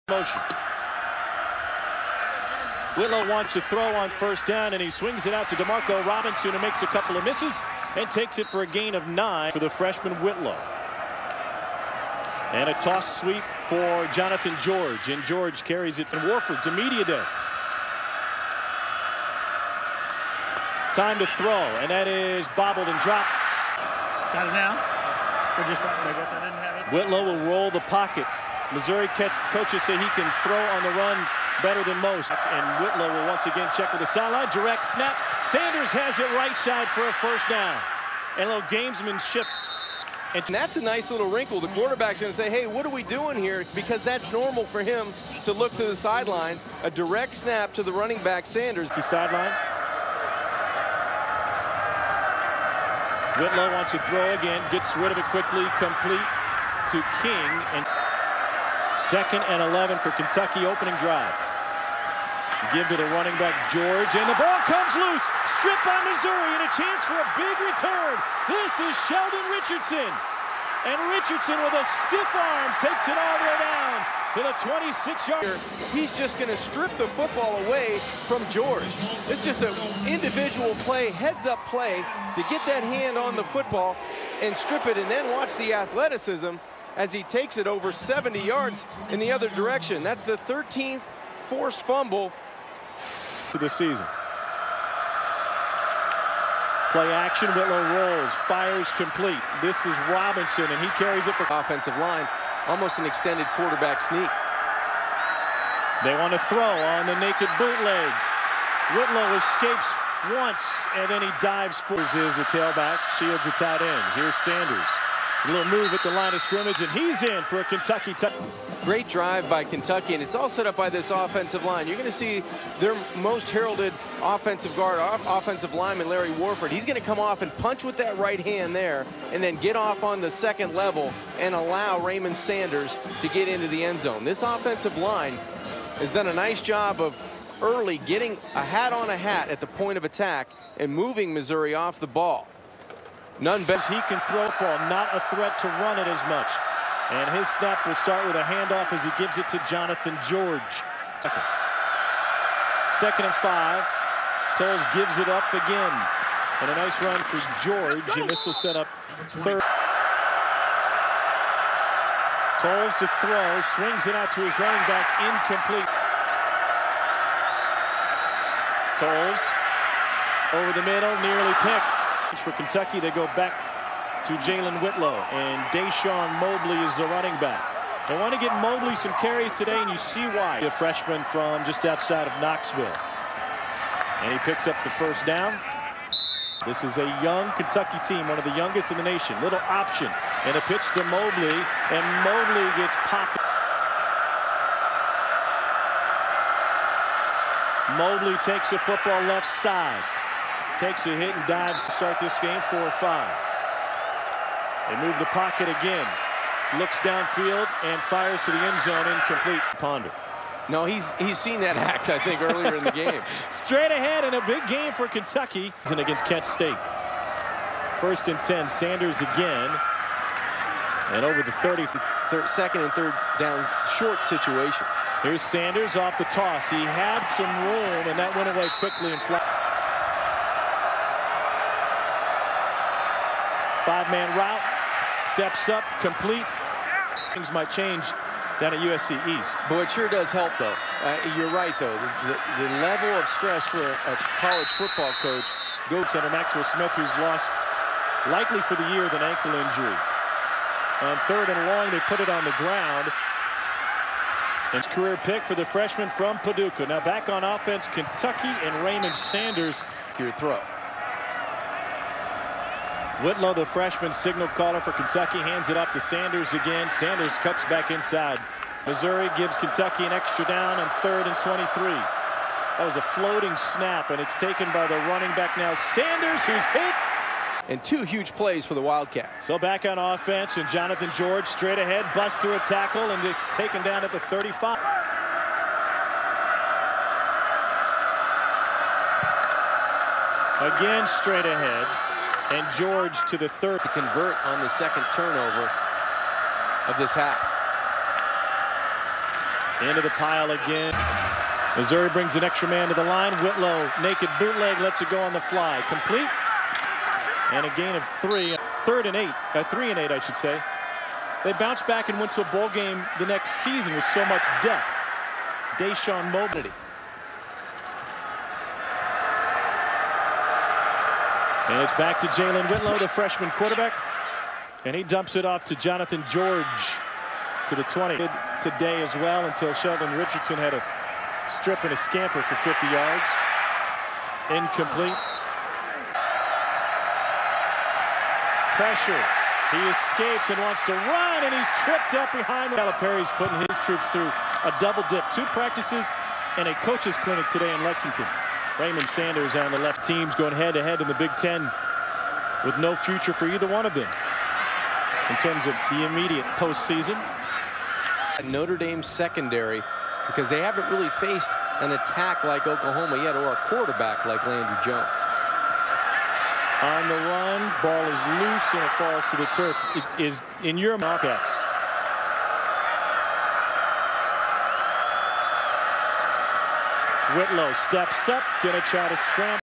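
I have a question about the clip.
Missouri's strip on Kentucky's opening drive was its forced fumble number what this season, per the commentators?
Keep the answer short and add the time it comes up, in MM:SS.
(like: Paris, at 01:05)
13th, at 01:30.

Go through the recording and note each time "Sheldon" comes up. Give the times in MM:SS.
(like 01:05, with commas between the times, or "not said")
01:09, 05:29.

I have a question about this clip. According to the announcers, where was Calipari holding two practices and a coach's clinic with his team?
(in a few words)
Lexington.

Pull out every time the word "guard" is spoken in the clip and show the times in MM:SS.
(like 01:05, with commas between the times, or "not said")
02:04.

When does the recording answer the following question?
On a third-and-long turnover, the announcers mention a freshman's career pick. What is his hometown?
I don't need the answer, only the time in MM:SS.
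04:16.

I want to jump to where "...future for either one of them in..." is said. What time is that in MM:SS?
05:52.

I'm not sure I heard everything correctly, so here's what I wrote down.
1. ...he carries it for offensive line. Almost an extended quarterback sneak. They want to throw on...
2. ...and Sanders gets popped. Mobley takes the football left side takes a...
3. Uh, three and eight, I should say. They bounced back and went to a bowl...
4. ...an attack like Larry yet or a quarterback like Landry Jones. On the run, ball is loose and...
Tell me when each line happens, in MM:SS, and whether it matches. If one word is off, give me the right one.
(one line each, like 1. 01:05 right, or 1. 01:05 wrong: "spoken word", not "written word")
1. 01:40 right
2. 03:11 wrong: "Mobley", not "Sanders"
3. 05:09 right
4. 06:01 wrong: "Oklahoma", not "Larry".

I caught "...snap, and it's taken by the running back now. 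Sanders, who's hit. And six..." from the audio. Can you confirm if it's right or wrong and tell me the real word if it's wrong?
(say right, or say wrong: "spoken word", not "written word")
wrong: "two", not "six".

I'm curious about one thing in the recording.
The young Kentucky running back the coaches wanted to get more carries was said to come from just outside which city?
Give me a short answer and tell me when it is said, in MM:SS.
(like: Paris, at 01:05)
Knoxville, at 03:02.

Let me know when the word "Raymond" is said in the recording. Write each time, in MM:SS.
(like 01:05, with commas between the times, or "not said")
02:11, 04:18, 05:48.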